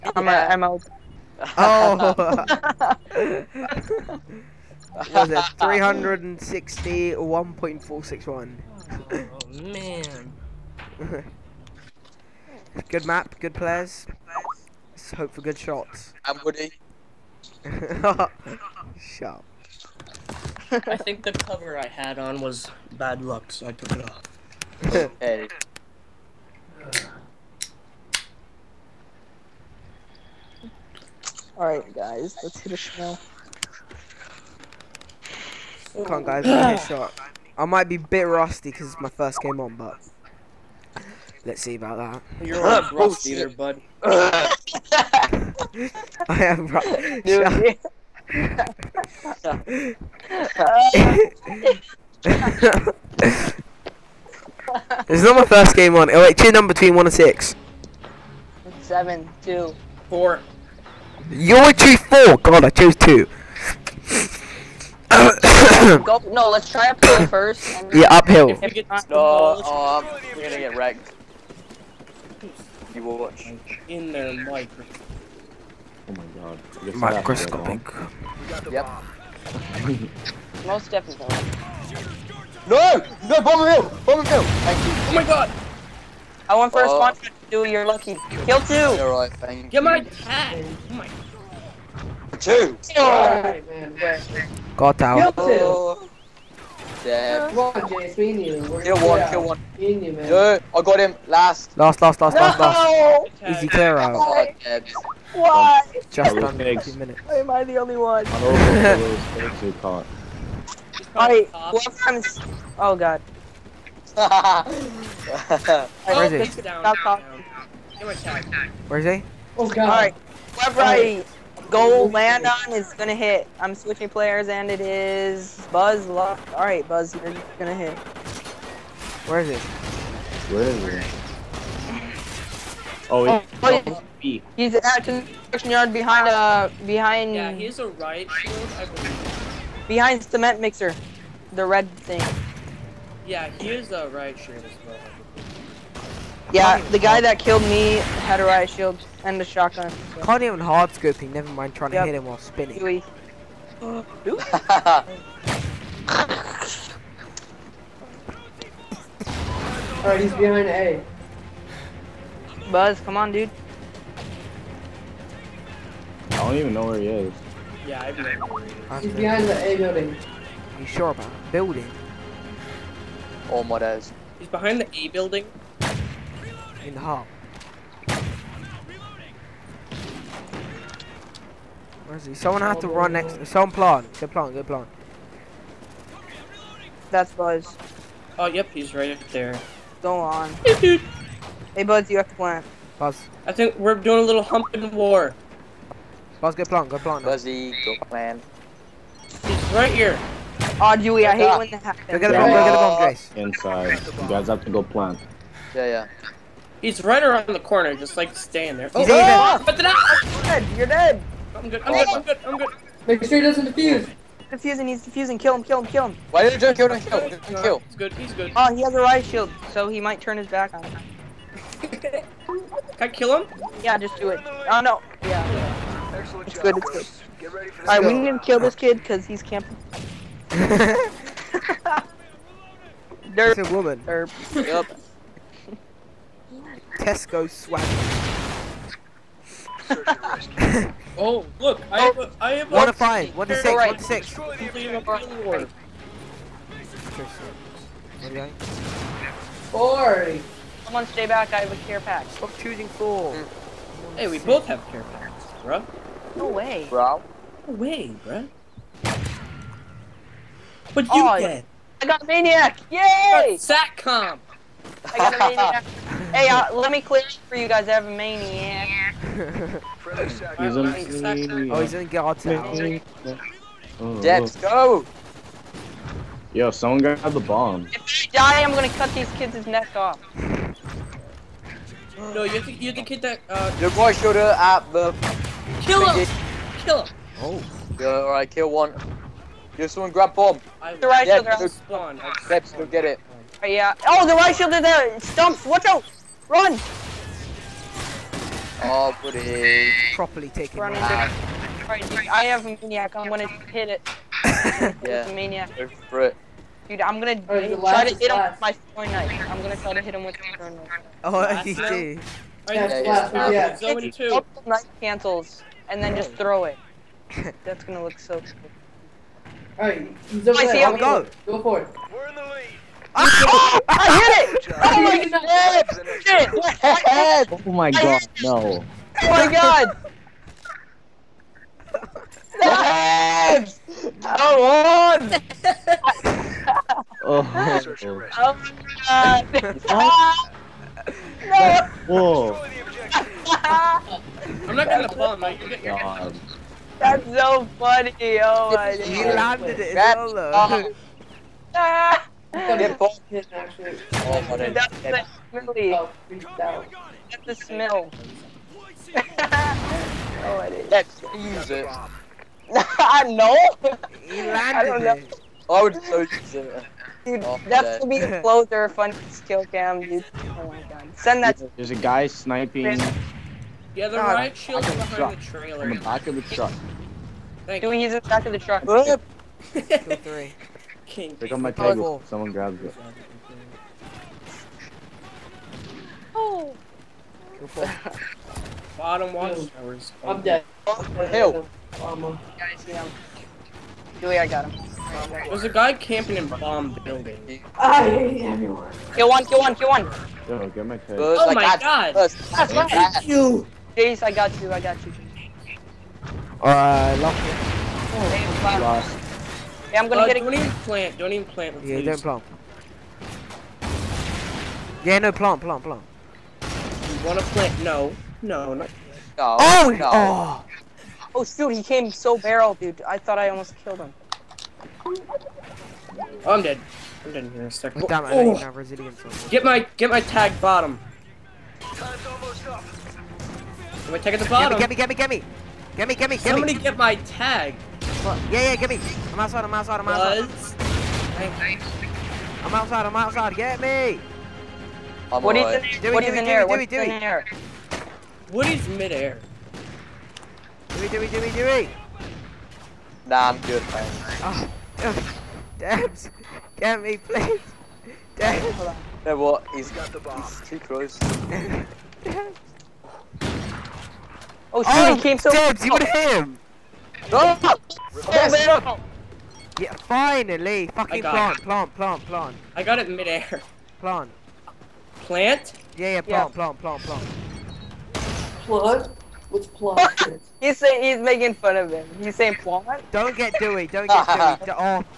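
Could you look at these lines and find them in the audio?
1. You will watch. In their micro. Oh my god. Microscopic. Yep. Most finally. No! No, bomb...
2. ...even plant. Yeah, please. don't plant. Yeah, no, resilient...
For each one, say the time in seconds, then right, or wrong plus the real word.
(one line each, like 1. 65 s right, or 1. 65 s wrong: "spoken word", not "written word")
1. 72 s wrong: "definitely", not "finally"
2. 411 s wrong: "plant", not "resilient".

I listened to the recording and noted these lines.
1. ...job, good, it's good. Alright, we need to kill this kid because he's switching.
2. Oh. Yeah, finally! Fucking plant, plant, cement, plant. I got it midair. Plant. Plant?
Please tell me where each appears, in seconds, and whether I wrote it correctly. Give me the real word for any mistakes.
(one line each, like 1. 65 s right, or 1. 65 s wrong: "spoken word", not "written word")
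1. 226 s wrong: "camping", not "switching"
2. 468 s wrong: "plant", not "cement".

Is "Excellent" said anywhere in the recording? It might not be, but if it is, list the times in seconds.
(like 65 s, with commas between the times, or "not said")
226 s.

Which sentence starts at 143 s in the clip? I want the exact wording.
Yeah, he is a riot shield as well.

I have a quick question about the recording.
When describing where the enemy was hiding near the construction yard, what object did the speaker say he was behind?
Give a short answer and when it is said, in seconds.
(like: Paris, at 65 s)
cement mixer, at 140 s.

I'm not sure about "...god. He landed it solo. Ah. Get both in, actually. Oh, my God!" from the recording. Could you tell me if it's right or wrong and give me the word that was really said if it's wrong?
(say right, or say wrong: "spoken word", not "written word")
right.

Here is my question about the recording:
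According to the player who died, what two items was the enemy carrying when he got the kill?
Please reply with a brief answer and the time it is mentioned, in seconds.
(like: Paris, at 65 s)
riot shield and a shotgun, at 148 s.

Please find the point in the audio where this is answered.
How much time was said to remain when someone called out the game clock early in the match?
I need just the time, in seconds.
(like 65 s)
106 s.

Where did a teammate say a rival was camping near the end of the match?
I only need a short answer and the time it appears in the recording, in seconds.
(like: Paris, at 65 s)
bomb building, at 395 s.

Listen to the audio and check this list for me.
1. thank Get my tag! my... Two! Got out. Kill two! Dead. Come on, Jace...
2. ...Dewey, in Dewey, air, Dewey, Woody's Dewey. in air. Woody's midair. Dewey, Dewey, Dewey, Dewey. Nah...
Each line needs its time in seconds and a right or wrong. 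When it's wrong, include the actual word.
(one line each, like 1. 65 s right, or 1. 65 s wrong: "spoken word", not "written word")
1. 89 s right
2. 446 s right.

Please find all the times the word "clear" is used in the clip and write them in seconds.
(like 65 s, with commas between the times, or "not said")
103 s, 267 s.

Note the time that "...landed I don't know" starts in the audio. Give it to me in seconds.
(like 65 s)
364 s.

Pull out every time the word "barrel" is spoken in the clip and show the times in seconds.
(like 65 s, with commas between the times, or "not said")
422 s.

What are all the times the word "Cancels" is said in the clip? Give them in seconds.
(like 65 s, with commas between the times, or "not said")
314 s.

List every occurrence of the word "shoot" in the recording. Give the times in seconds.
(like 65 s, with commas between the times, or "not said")
421 s, 464 s.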